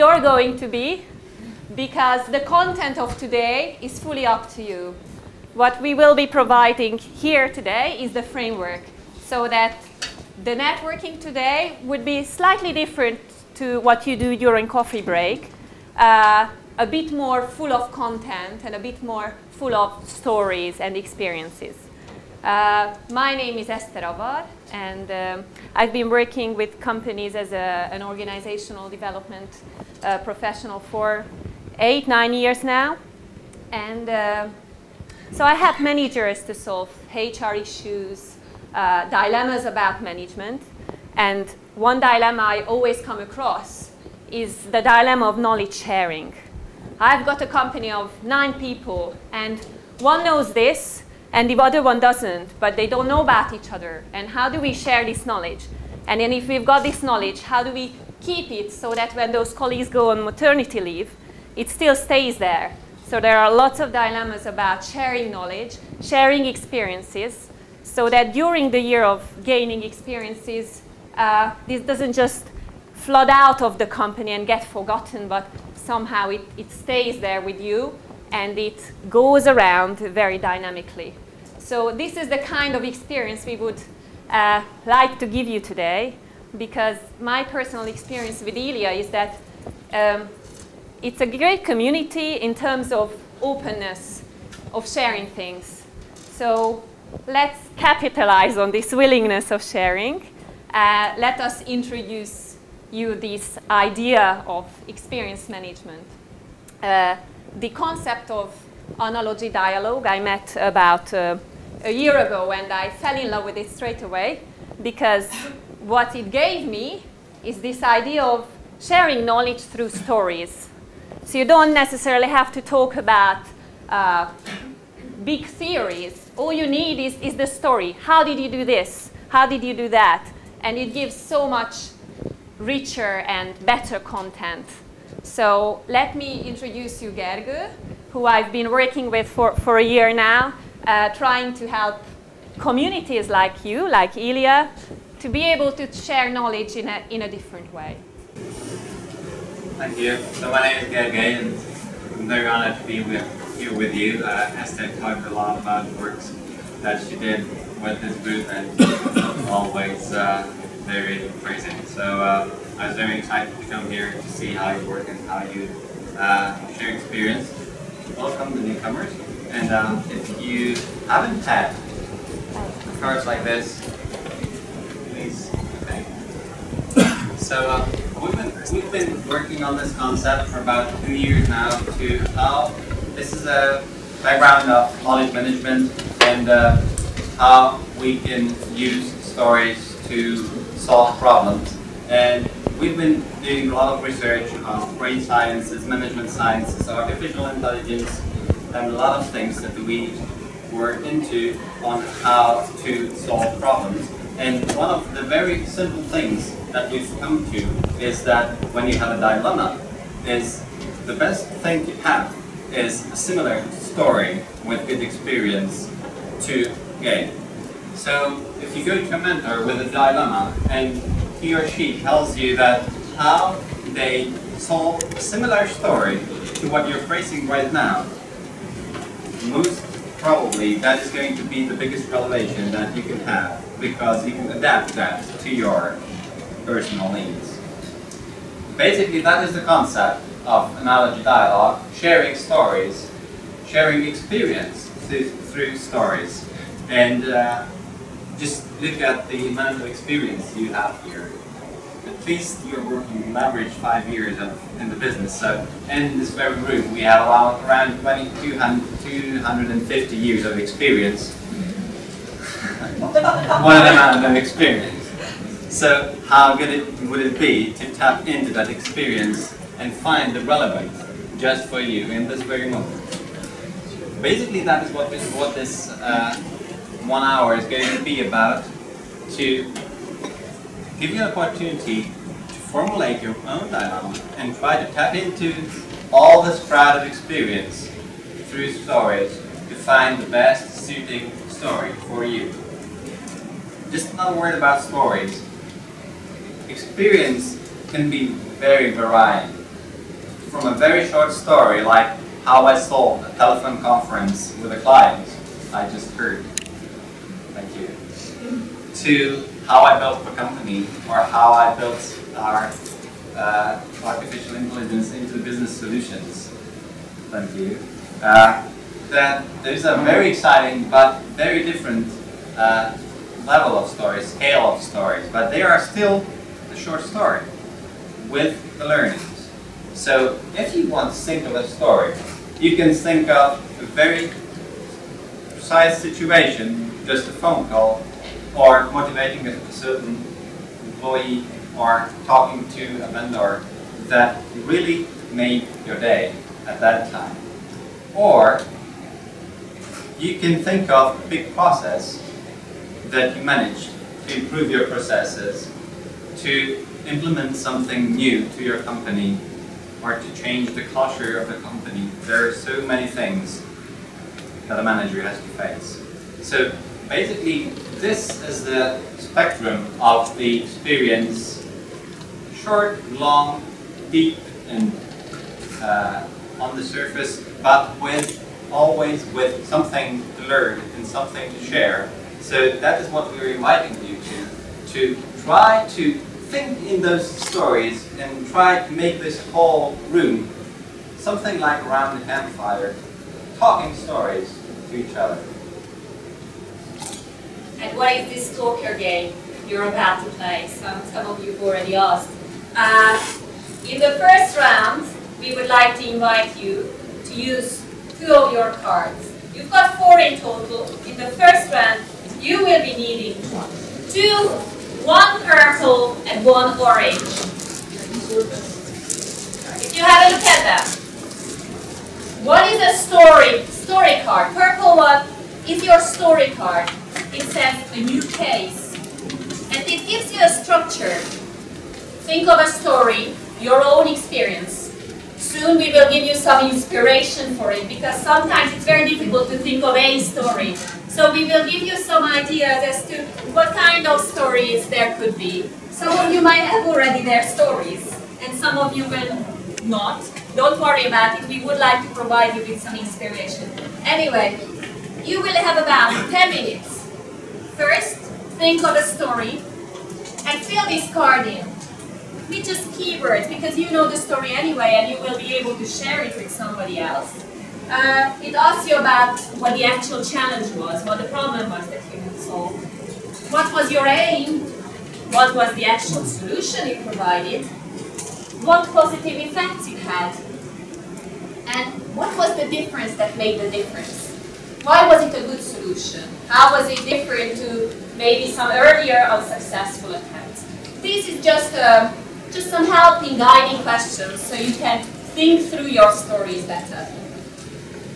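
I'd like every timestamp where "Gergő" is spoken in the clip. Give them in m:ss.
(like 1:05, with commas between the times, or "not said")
2:17, 2:30.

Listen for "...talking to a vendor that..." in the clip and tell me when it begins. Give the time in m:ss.
5:42.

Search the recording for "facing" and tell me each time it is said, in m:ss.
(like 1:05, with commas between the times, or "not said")
3:47.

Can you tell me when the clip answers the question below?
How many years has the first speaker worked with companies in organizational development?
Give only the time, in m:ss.
0:31.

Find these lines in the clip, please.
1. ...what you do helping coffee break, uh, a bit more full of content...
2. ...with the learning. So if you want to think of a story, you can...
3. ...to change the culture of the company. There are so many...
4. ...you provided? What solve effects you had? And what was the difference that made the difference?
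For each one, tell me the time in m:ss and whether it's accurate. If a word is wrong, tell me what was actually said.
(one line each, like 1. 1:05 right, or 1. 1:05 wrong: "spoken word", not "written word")
1. 0:13 wrong: "during", not "helping"
2. 5:28 right
3. 6:00 right
4. 7:56 wrong: "positive", not "solve".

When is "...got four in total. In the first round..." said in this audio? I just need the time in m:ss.
6:49.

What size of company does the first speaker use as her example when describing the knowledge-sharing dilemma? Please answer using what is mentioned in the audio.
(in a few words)
9 people.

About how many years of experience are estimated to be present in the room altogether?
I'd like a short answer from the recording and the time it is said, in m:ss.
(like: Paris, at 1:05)
250 years, at 4:17.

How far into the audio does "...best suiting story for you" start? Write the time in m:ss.
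4:50.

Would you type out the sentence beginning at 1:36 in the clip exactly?
So let's capitalize on this willingness of sharing.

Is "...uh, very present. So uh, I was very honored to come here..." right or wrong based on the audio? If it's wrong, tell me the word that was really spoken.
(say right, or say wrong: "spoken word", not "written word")
wrong: "excited", not "honored".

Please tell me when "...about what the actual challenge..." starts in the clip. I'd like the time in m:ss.
7:48.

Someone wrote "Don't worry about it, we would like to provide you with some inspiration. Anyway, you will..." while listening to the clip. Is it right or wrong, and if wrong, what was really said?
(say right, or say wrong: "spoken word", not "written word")
right.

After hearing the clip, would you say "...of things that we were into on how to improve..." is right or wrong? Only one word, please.
wrong.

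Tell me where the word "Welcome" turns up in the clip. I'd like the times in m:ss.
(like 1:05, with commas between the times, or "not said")
2:48.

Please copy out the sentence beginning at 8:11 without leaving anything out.
This is just, uh, just some helping, guiding questions so you can think through your stories better.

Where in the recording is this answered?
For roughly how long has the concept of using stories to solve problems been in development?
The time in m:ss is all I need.
3:00.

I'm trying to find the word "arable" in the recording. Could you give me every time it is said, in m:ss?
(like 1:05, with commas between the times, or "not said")
not said.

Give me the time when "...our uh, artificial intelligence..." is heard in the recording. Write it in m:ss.
5:12.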